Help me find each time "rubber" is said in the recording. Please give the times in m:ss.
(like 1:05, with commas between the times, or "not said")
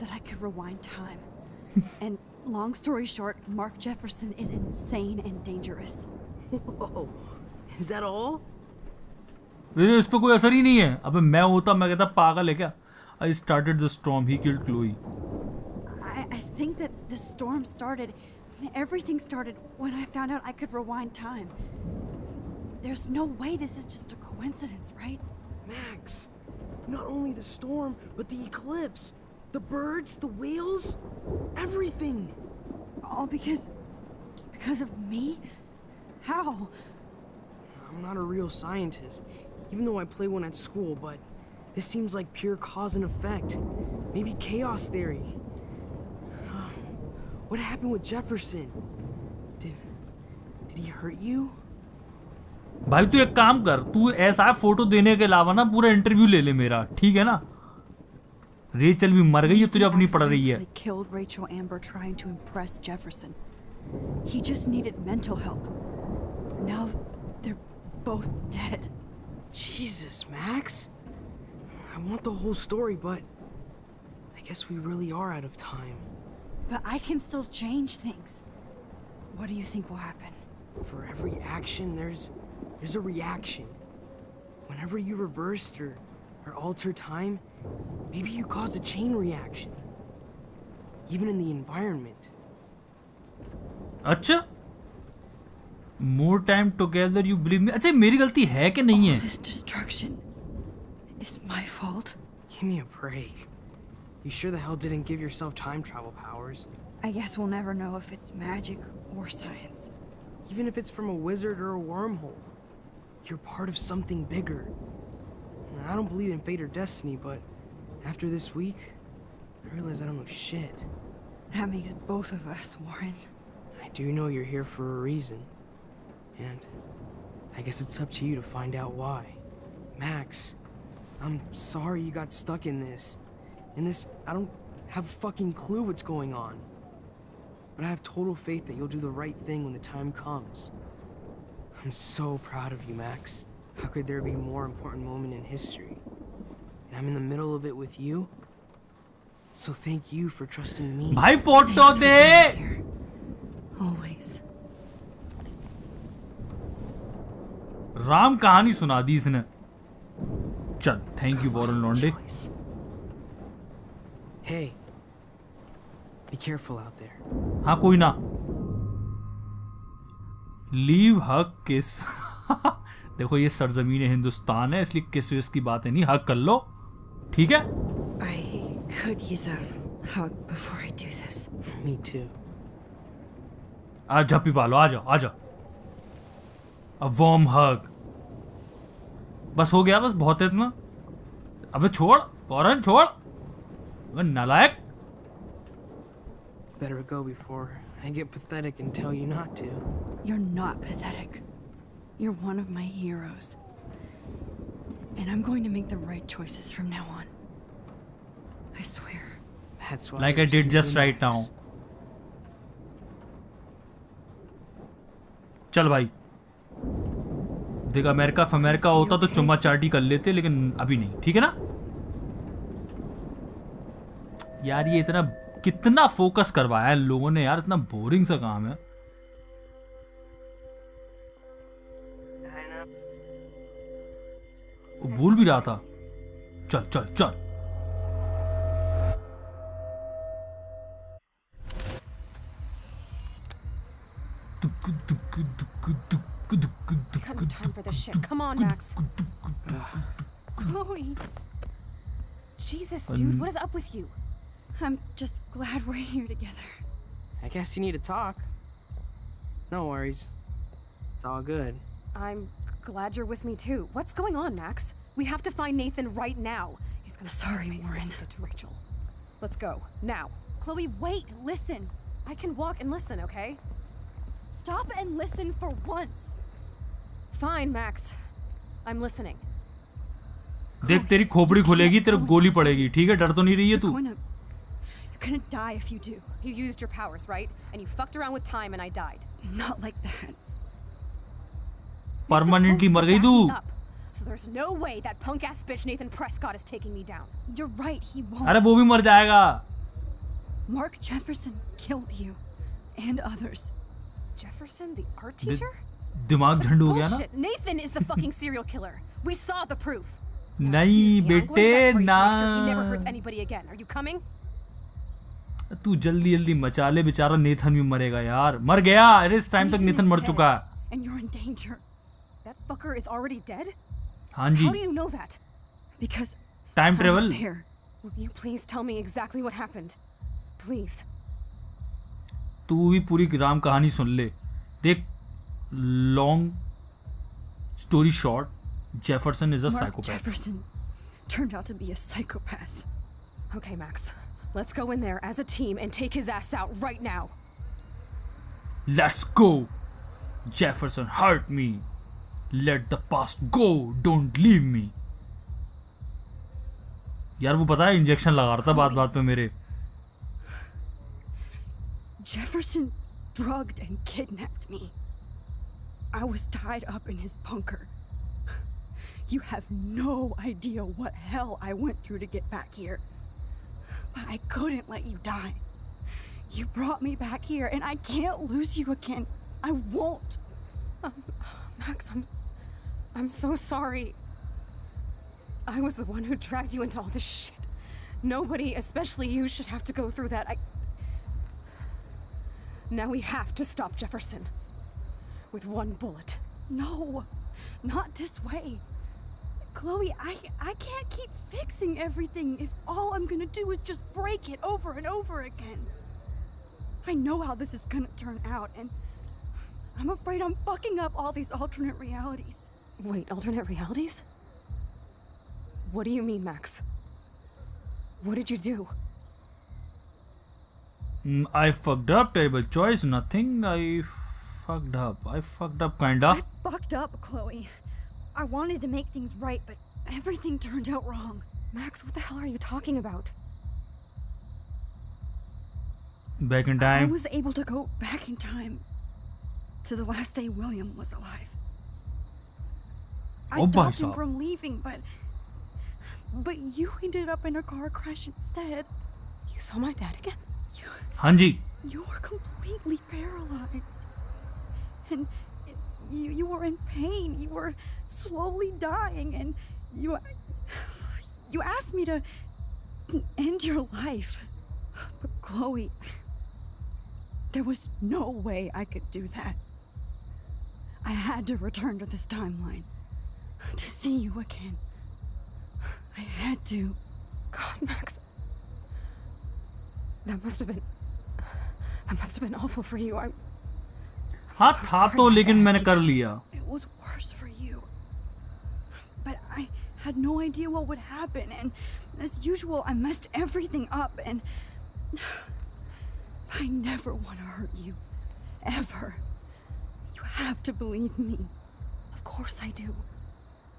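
not said.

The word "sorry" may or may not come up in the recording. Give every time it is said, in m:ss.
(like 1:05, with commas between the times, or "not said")
2:11, 4:27, 6:23.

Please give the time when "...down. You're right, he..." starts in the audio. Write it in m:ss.
4:57.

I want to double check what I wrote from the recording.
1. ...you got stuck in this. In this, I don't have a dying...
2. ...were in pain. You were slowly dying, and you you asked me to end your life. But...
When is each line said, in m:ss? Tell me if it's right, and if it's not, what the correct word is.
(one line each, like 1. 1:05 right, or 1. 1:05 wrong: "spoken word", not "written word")
1. 2:12 wrong: "fucking", not "dying"
2. 7:36 right.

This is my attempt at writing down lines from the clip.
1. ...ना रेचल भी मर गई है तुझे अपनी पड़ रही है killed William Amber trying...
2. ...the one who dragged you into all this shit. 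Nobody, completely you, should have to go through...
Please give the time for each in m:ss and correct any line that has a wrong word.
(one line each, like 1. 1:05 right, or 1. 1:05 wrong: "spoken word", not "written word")
1. 0:57 wrong: "Rachel", not "William"
2. 6:25 wrong: "especially", not "completely".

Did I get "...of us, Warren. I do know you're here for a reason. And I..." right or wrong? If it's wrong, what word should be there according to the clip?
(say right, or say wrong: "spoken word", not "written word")
right.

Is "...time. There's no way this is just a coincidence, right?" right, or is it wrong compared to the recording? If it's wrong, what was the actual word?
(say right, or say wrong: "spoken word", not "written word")
right.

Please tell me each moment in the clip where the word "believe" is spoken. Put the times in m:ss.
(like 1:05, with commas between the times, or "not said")
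1:37, 1:56, 8:20.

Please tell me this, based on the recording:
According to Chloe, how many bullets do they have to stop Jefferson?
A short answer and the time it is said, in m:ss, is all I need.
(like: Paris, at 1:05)
1, at 6:35.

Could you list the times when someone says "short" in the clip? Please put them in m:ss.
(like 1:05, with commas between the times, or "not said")
0:03, 5:38.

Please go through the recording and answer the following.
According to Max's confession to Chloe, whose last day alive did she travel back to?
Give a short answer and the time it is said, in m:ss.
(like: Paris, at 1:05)
William, at 7:20.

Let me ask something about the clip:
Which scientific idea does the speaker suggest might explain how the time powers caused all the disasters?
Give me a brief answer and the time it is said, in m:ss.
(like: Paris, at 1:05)
chaos theory, at 0:44.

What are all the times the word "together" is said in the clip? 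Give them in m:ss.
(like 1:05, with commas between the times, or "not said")
1:36, 4:16.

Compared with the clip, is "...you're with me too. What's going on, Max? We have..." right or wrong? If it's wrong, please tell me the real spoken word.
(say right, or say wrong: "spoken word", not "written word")
right.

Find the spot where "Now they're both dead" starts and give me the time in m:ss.
1:06.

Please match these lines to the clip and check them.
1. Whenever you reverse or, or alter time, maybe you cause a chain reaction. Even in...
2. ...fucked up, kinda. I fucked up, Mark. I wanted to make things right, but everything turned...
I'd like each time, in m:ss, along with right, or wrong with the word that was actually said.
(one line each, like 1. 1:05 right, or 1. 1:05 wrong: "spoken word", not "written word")
1. 1:24 right
2. 7:05 wrong: "Chloe", not "Mark".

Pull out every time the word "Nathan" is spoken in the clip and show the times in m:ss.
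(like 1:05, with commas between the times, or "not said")
4:25, 4:55.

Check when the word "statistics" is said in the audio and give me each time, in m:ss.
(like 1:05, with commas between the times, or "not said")
not said.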